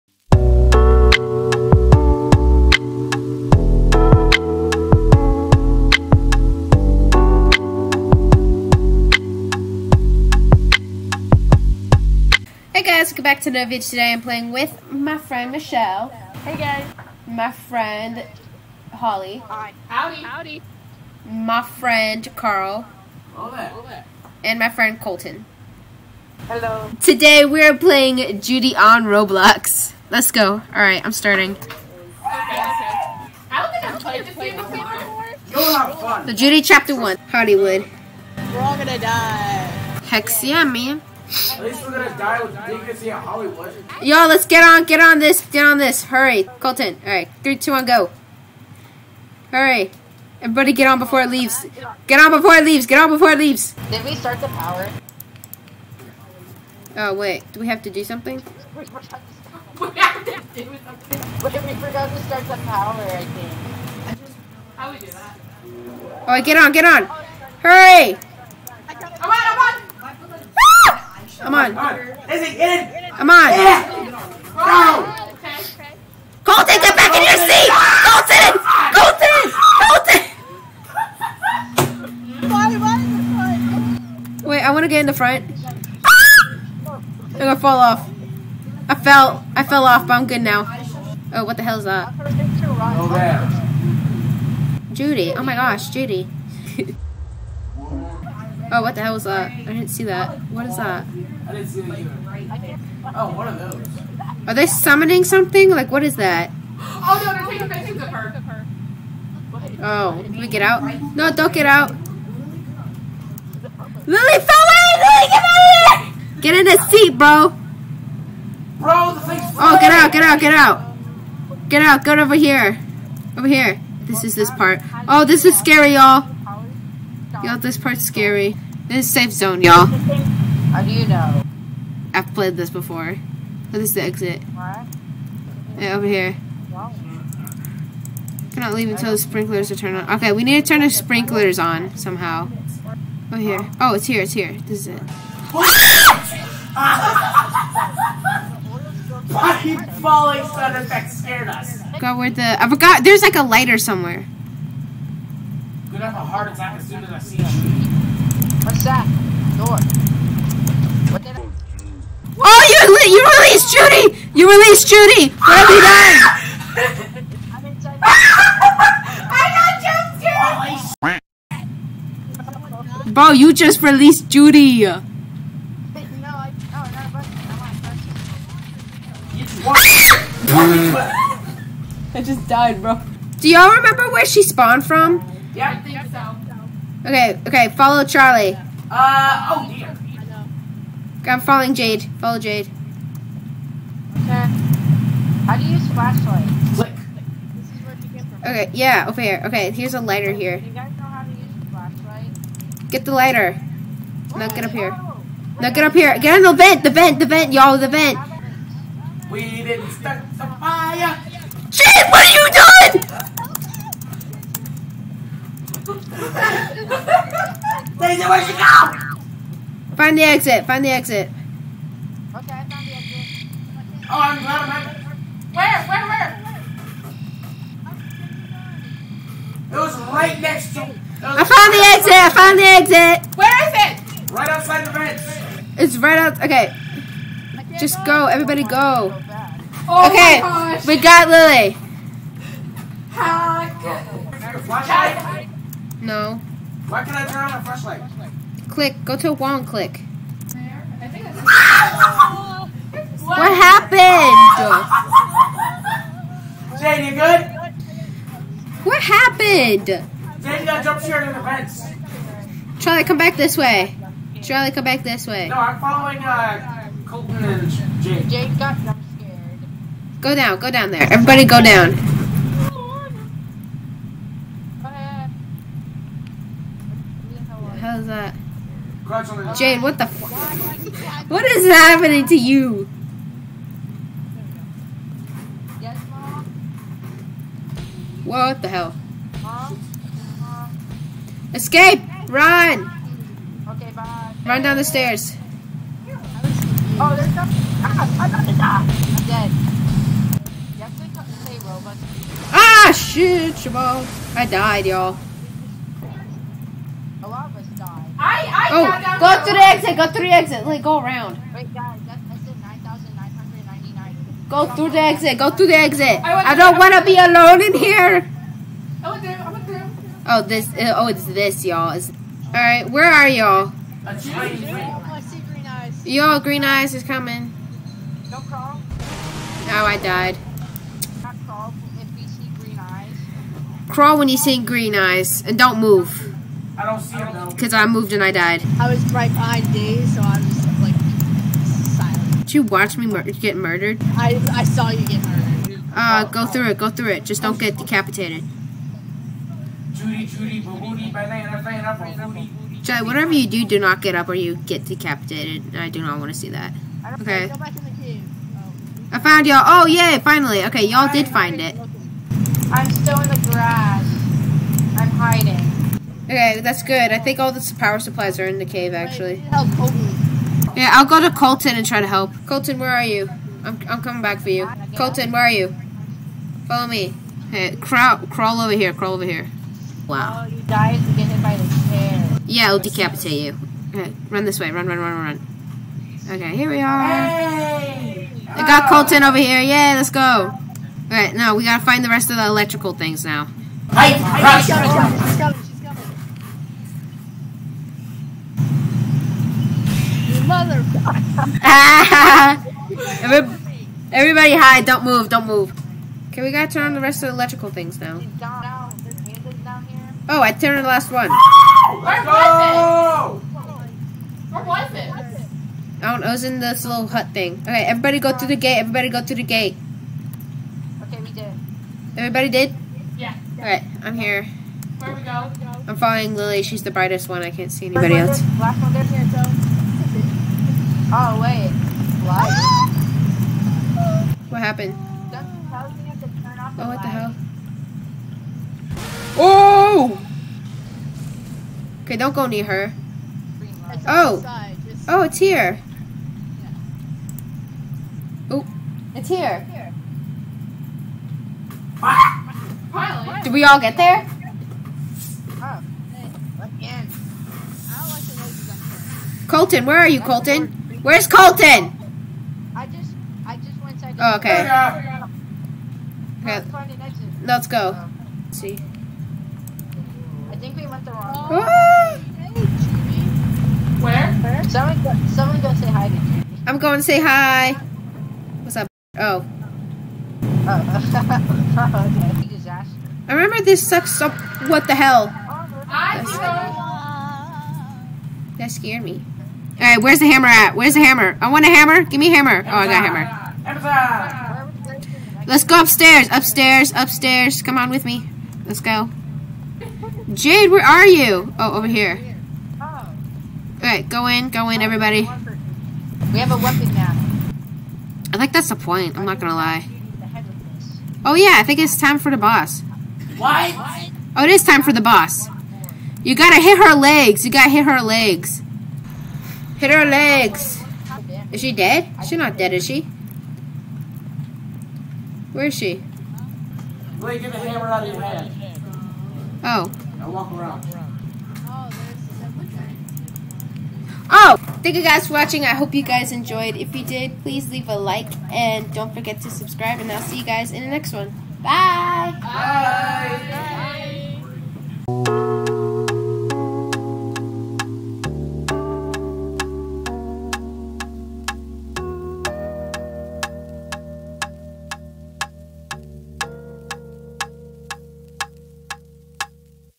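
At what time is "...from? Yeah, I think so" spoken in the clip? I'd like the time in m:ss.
3:04.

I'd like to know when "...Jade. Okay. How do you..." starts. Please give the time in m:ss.
3:12.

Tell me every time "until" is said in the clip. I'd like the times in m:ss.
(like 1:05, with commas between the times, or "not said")
2:18.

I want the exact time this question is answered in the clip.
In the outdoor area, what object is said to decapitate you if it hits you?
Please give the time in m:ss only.
6:21.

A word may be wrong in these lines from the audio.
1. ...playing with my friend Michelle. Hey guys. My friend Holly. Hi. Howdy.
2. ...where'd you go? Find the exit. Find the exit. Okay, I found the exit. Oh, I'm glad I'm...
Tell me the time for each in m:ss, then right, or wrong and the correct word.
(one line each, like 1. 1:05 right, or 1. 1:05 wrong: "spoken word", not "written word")
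1. 0:14 right
2. 3:38 right.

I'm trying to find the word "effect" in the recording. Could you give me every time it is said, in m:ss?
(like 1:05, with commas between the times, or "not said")
2:30.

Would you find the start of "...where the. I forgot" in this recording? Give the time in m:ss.
2:32.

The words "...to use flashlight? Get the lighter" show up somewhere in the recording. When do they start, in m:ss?
3:21.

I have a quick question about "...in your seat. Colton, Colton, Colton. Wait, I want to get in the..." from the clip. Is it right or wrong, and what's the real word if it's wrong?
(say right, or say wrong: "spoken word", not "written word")
right.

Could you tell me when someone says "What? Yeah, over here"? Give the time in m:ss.
2:14.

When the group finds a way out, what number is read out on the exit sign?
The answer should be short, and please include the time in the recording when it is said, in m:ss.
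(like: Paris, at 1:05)
9,999, at 5:12.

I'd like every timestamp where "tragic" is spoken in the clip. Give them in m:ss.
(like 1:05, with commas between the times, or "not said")
not said.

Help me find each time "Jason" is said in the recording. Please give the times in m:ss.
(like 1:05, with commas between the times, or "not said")
not said.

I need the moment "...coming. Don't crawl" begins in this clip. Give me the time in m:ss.
5:27.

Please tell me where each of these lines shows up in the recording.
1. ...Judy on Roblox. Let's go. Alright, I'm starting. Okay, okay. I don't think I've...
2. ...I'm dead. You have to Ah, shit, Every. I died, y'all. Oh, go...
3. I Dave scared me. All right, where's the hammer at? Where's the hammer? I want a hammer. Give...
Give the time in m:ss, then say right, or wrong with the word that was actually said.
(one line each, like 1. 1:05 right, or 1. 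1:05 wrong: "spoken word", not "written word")
1. 0:28 right
2. 4:58 wrong: "Jamal", not "Every"
3. 8:05 wrong: "That", not "Dave".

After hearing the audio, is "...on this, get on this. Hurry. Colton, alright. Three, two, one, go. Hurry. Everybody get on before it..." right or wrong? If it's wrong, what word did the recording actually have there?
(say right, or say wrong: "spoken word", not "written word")
right.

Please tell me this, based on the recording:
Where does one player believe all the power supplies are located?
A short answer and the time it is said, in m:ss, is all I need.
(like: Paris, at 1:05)
In the cave, at 6:08.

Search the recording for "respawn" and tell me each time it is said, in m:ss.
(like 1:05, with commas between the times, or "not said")
not said.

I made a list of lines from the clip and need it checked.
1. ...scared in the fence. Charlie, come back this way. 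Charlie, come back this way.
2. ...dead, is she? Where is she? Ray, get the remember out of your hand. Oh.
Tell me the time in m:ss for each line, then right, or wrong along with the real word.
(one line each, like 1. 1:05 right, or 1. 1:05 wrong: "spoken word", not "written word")
1. 4:21 right
2. 8:42 wrong: "hammer", not "remember".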